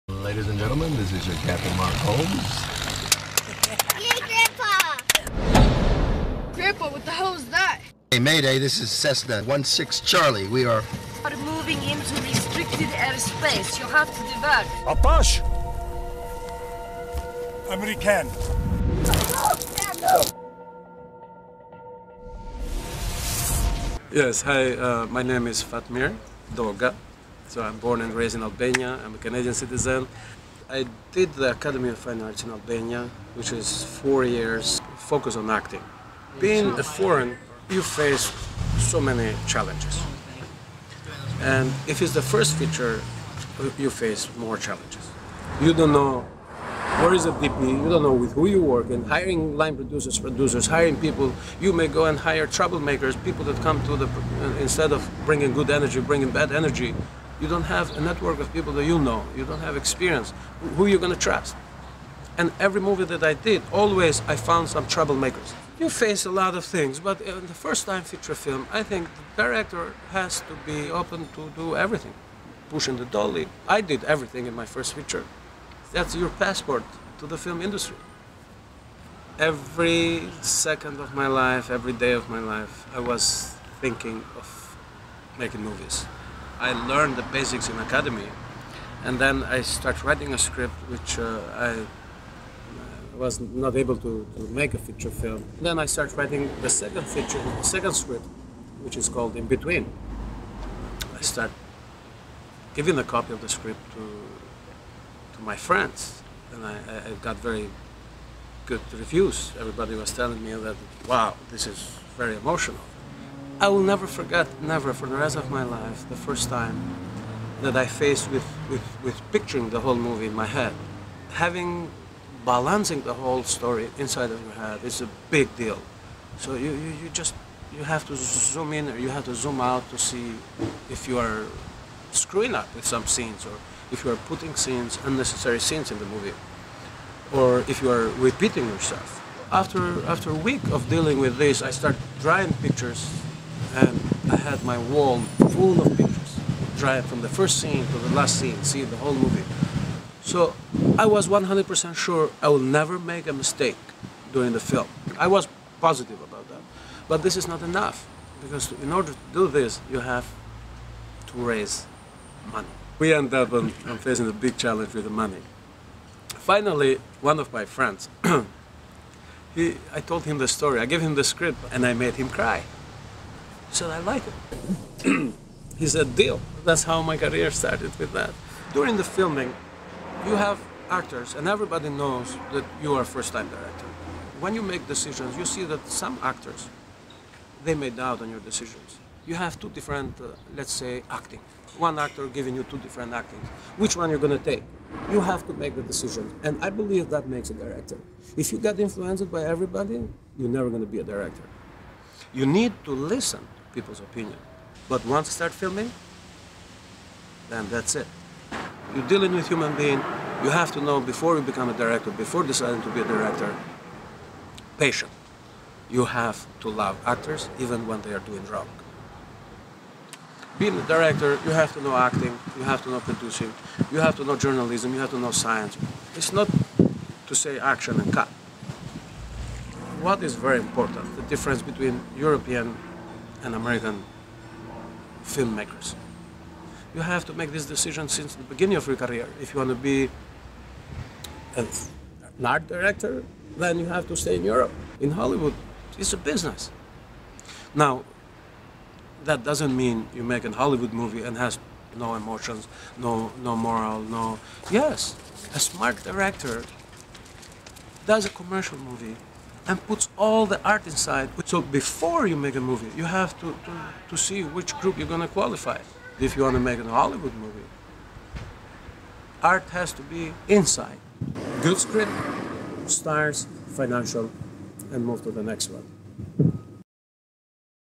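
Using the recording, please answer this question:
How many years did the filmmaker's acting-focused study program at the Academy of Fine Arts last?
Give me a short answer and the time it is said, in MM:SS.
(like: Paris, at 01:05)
4, at 00:33.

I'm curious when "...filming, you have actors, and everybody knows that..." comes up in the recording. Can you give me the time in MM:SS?
02:59.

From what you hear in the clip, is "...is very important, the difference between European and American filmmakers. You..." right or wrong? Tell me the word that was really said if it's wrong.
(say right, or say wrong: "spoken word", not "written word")
right.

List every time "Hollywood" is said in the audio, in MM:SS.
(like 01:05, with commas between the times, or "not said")
04:05, 04:10, 04:26.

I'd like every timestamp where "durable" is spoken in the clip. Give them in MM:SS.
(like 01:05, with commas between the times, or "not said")
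not said.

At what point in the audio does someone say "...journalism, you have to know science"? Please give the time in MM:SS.
03:44.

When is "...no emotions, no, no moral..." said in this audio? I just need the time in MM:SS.
04:11.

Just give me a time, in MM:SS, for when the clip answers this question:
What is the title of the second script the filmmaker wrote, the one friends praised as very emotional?
01:39.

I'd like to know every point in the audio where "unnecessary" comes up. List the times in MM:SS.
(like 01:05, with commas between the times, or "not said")
02:15.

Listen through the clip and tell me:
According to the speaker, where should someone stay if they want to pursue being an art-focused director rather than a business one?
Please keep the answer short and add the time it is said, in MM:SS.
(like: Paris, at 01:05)
Europe, at 04:03.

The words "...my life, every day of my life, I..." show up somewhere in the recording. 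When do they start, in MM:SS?
01:21.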